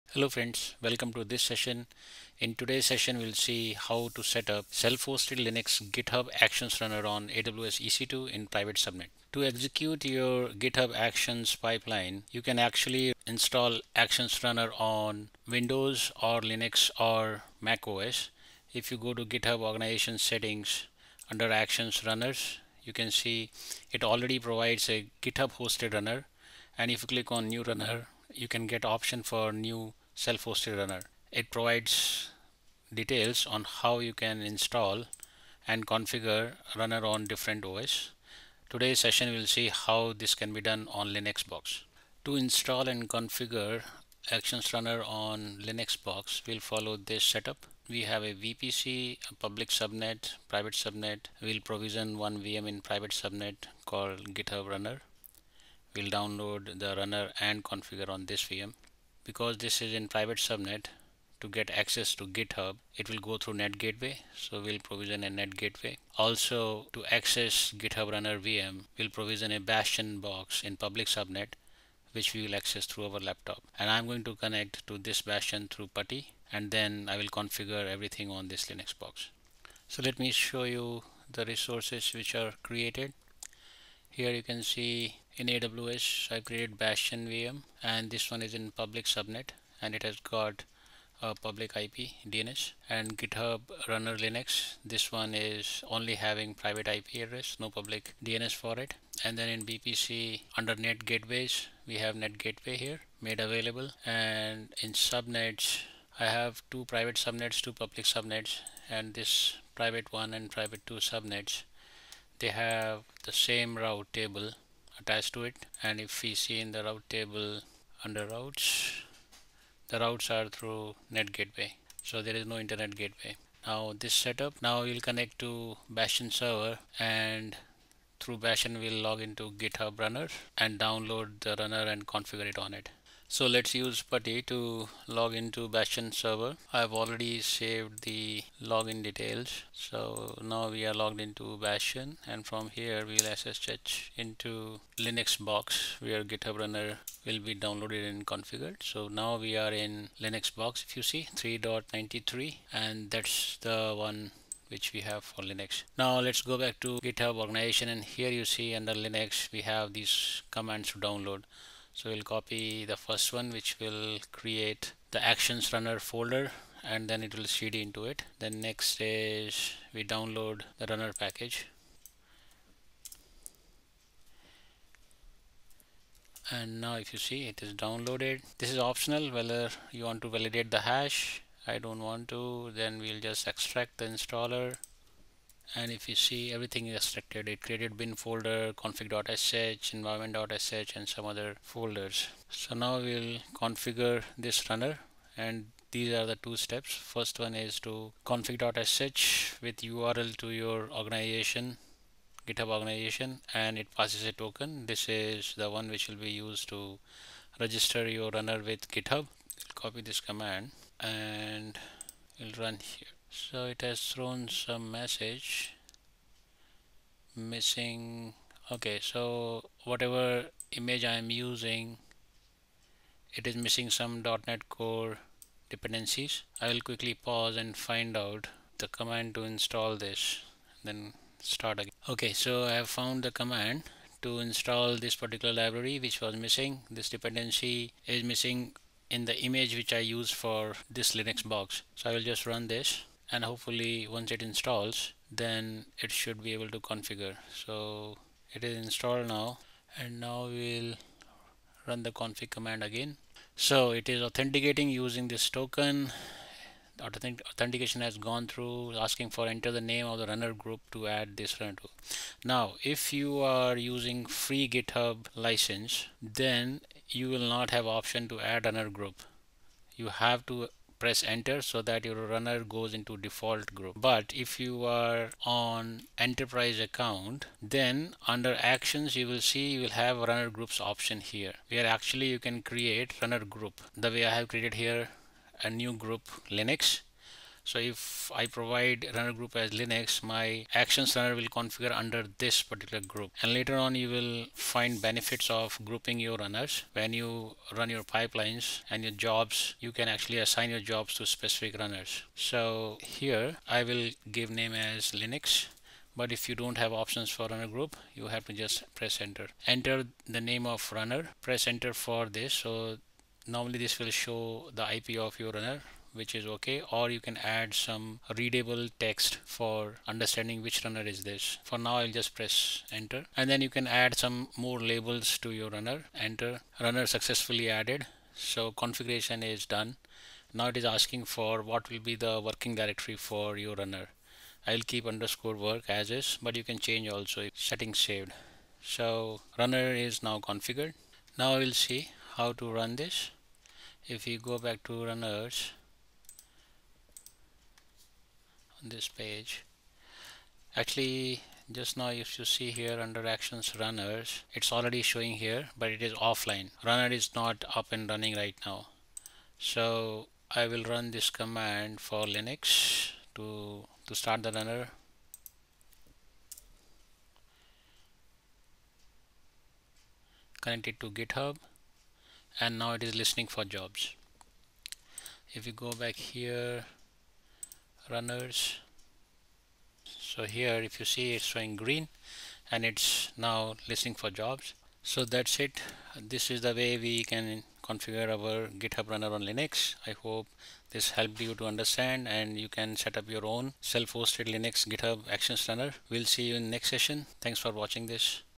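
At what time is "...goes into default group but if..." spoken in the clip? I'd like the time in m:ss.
4:32.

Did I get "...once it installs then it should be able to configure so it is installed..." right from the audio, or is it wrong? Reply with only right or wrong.
right.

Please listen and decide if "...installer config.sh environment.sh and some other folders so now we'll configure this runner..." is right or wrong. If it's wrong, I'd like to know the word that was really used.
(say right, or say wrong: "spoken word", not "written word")
wrong: "folder", not "installer".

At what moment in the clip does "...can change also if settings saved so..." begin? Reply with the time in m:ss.
5:36.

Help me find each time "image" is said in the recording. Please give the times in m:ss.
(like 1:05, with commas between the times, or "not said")
3:40, 3:59.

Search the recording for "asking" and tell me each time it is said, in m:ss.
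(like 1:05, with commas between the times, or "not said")
4:18, 5:30.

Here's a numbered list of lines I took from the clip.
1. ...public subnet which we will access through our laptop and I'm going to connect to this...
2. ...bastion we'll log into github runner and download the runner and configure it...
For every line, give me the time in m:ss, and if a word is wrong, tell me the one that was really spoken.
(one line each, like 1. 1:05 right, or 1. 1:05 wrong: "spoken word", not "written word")
1. 1:10 right
2. 2:08 right.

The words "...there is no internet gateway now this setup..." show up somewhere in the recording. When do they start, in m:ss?
2:02.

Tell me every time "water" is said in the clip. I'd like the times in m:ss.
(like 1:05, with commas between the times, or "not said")
not said.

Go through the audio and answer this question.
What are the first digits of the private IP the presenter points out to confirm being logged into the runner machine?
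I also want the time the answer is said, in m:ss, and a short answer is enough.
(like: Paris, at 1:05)
3.93, at 2:31.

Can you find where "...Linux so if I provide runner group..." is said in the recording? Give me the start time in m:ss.
4:46.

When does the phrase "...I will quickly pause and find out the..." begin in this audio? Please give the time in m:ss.
3:46.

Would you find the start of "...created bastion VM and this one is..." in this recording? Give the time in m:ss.
1:26.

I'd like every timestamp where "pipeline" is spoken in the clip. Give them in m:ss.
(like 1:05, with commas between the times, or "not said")
0:11, 4:58.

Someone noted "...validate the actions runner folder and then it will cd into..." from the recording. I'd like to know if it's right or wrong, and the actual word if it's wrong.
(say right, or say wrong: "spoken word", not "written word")
wrong: "create", not "validate".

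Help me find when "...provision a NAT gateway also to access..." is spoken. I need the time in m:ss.
1:04.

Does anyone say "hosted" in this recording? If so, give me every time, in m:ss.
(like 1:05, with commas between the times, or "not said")
0:04, 0:25, 0:30, 6:33.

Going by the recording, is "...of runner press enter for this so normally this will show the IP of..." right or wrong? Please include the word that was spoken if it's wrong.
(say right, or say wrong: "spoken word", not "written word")
right.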